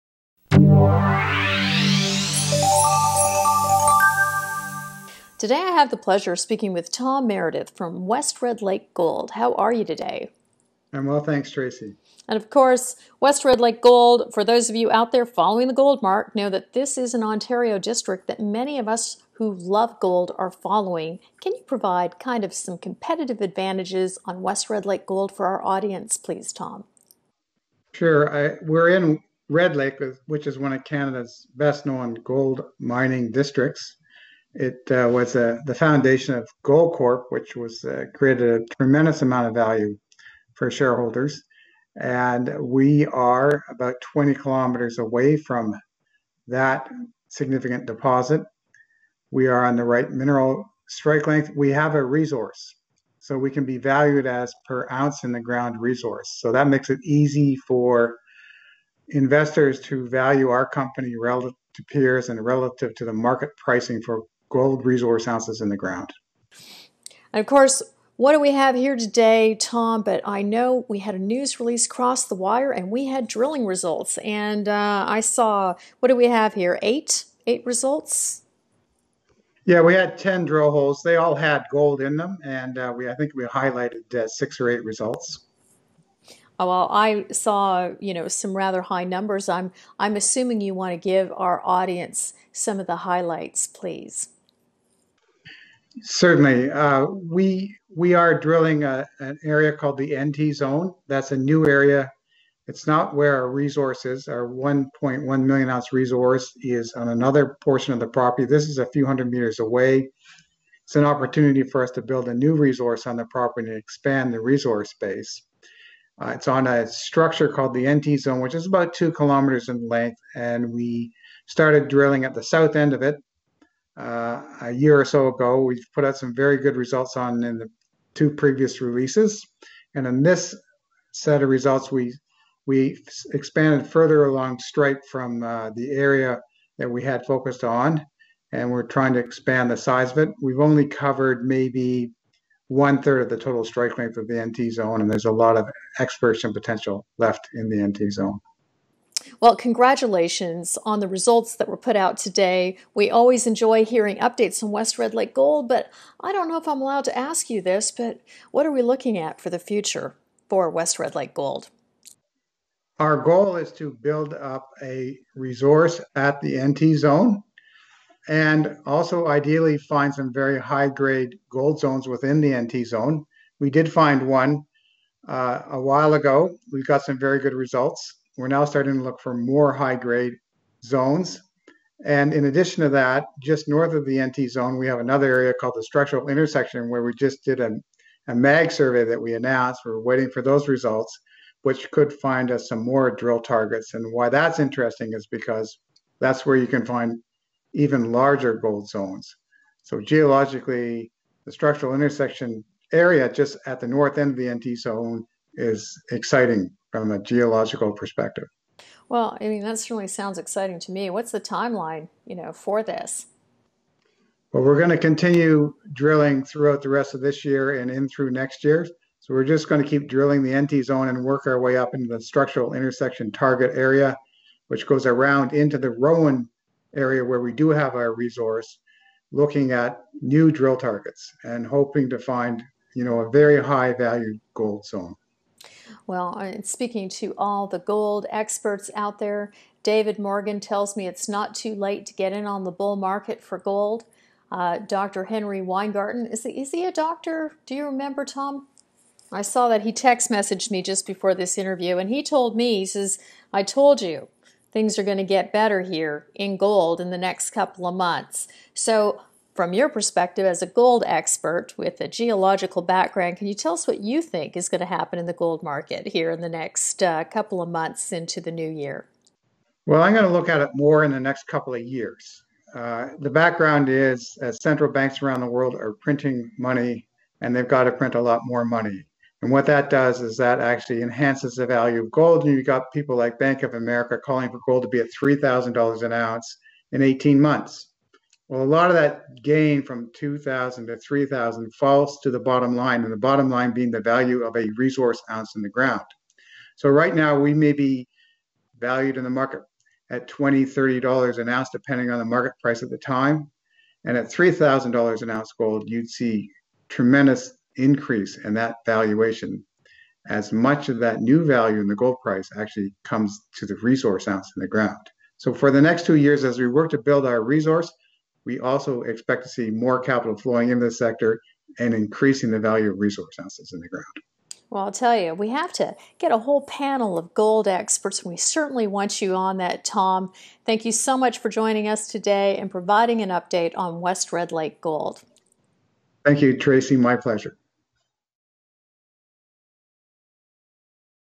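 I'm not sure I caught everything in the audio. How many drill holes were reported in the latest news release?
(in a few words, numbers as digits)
10.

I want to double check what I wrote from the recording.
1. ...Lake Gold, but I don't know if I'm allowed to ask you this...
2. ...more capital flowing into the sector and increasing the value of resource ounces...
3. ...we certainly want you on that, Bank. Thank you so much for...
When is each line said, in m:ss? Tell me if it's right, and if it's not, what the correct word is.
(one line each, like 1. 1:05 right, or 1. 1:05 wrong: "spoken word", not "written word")
1. 2:35 right
2. 5:19 right
3. 5:28 wrong: "Tom", not "Bank".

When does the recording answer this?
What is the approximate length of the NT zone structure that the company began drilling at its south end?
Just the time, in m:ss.
1:58.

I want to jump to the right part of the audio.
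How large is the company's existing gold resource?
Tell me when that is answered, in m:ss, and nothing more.
1:44.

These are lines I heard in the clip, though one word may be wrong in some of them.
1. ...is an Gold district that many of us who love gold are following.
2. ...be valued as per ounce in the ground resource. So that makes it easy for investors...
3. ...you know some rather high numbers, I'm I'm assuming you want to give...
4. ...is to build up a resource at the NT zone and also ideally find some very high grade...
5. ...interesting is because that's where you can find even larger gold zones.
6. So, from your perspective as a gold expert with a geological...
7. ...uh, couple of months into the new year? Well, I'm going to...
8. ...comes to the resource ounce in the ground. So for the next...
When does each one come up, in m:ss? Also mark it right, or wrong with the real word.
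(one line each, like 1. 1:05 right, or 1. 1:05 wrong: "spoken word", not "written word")
1. 0:16 wrong: "Ontario", not "Gold"
2. 0:53 right
3. 1:27 right
4. 2:43 right
5. 3:14 right
6. 4:18 right
7. 4:27 right
8. 5:13 right.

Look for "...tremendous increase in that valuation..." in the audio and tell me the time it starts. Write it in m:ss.
5:06.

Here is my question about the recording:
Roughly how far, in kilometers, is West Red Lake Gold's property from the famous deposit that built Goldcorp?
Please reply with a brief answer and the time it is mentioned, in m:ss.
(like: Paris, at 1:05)
20 kilometers, at 0:44.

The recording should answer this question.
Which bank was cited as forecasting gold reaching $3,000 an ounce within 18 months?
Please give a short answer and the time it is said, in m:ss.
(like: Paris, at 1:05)
Bank of America, at 4:43.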